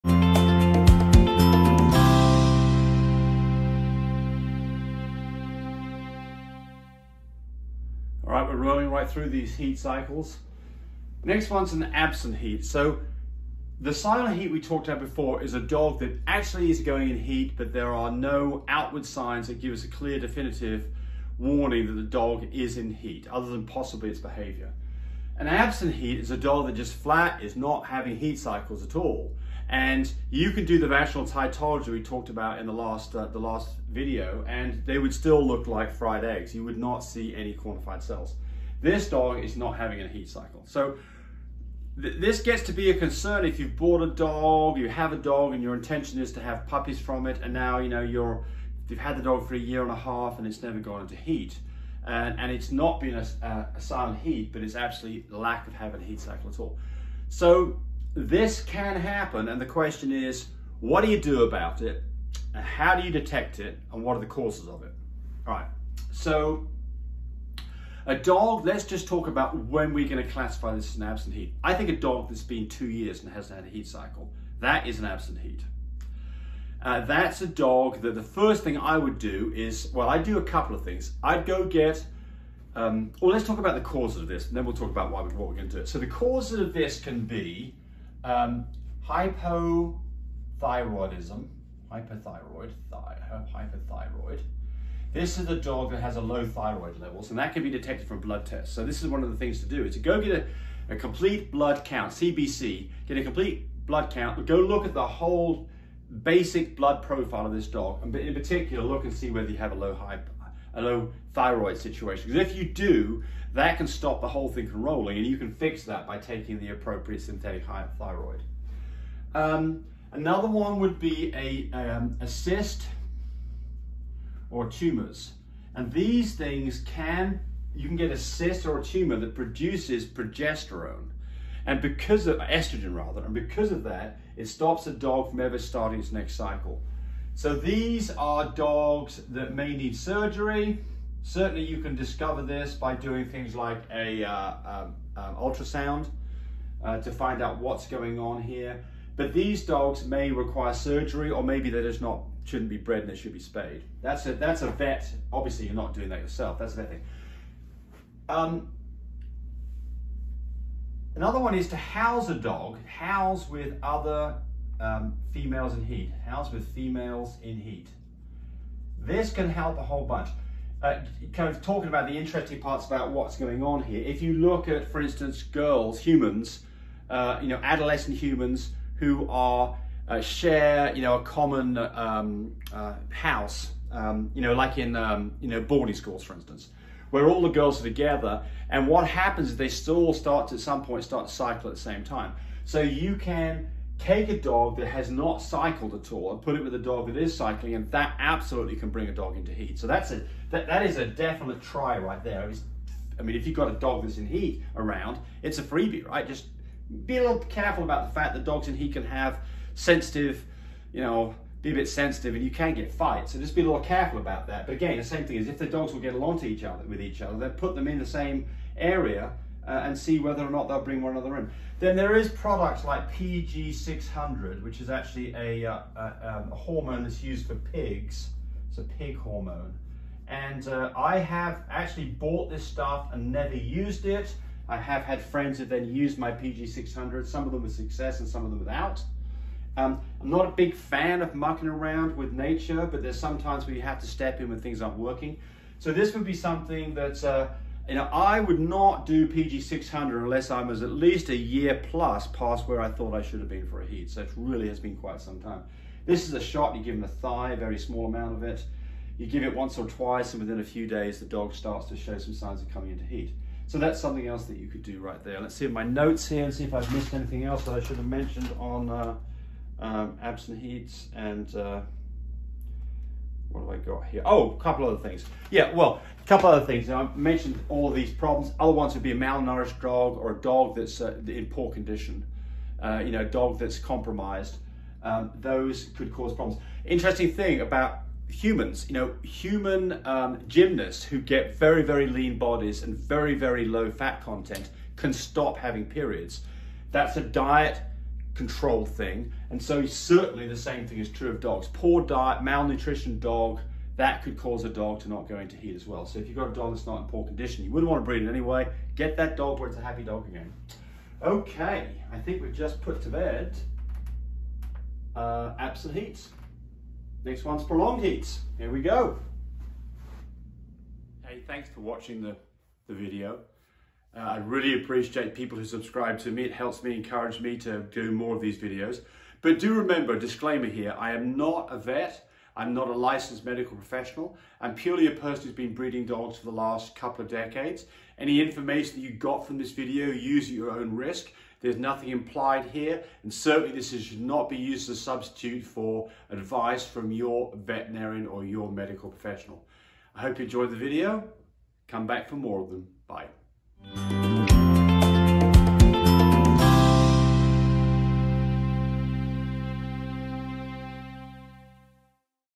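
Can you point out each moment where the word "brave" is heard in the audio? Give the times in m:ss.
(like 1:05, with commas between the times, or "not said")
not said.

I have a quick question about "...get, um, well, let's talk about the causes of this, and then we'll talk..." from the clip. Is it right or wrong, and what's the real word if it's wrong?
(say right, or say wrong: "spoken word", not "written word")
right.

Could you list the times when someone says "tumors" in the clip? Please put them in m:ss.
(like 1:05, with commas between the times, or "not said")
2:04, 2:08.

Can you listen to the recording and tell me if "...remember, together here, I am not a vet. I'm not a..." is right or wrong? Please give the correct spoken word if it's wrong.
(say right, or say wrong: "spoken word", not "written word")
wrong: "disclaimer", not "together".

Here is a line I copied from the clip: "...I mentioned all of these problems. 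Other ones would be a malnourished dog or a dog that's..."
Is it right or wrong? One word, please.
right.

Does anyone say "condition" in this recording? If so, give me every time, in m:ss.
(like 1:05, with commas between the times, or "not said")
4:41, 5:07.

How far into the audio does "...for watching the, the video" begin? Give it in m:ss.
5:21.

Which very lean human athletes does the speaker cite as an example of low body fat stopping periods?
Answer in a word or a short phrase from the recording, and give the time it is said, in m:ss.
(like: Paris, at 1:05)
gymnasts, at 4:50.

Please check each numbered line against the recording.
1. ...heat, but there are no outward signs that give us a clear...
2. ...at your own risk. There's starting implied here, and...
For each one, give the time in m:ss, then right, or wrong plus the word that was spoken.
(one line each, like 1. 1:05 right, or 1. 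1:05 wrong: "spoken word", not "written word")
1. 0:17 right
2. 5:40 wrong: "nothing", not "starting".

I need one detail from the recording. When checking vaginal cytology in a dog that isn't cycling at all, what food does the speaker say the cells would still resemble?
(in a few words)
fried eggs.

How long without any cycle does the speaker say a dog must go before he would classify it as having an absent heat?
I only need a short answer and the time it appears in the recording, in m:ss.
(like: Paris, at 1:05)
2 years, at 1:12.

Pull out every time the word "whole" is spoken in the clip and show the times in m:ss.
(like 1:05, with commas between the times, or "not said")
1:45, 1:54, 2:49.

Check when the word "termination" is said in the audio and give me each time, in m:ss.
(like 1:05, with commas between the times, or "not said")
not said.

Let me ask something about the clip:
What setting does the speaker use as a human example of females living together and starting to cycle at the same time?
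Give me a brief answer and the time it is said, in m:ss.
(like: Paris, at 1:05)
boarding schools, at 3:05.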